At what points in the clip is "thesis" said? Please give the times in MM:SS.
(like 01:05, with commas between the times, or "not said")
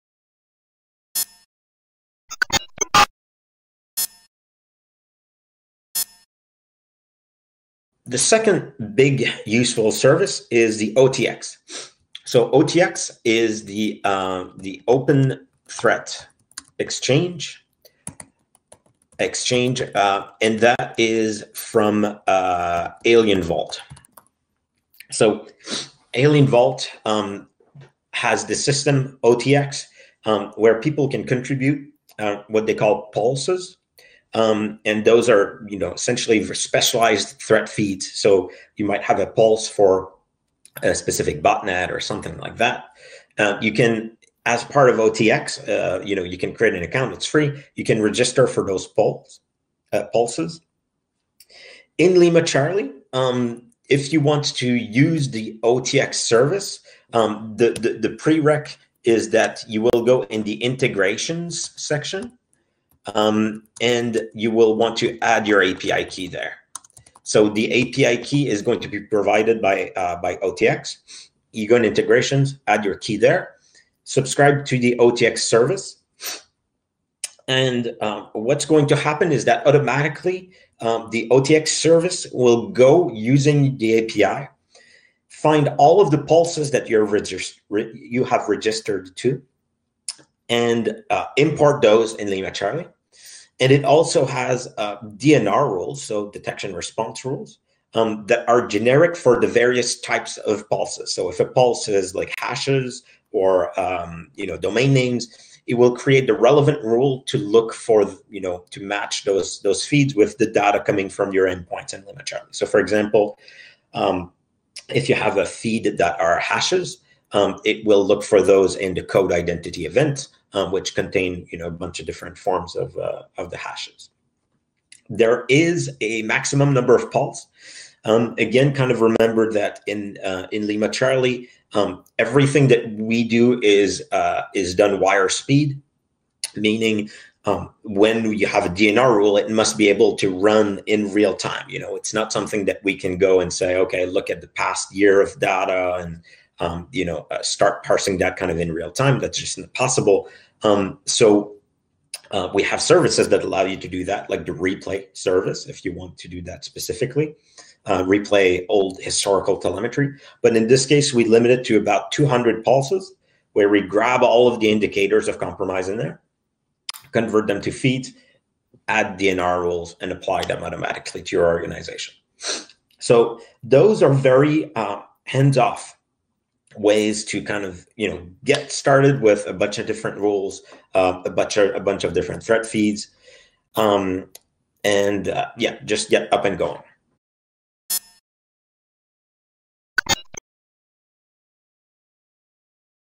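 not said.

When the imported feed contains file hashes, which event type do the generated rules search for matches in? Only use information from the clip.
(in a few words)
code identity.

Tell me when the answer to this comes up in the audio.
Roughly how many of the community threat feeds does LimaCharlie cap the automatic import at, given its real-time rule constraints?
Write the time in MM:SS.
02:42.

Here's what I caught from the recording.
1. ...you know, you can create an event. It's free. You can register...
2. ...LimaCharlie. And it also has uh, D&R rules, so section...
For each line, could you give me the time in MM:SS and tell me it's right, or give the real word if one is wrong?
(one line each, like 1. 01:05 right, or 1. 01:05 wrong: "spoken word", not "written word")
1. 00:46 wrong: "account", not "event"
2. 01:32 wrong: "detection", not "section".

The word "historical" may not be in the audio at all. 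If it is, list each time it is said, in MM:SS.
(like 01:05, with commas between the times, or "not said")
02:39.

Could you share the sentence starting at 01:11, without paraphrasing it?
You go in integrations, add your key there, subscribe to the OTX service.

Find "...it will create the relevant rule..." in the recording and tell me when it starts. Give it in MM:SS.
01:45.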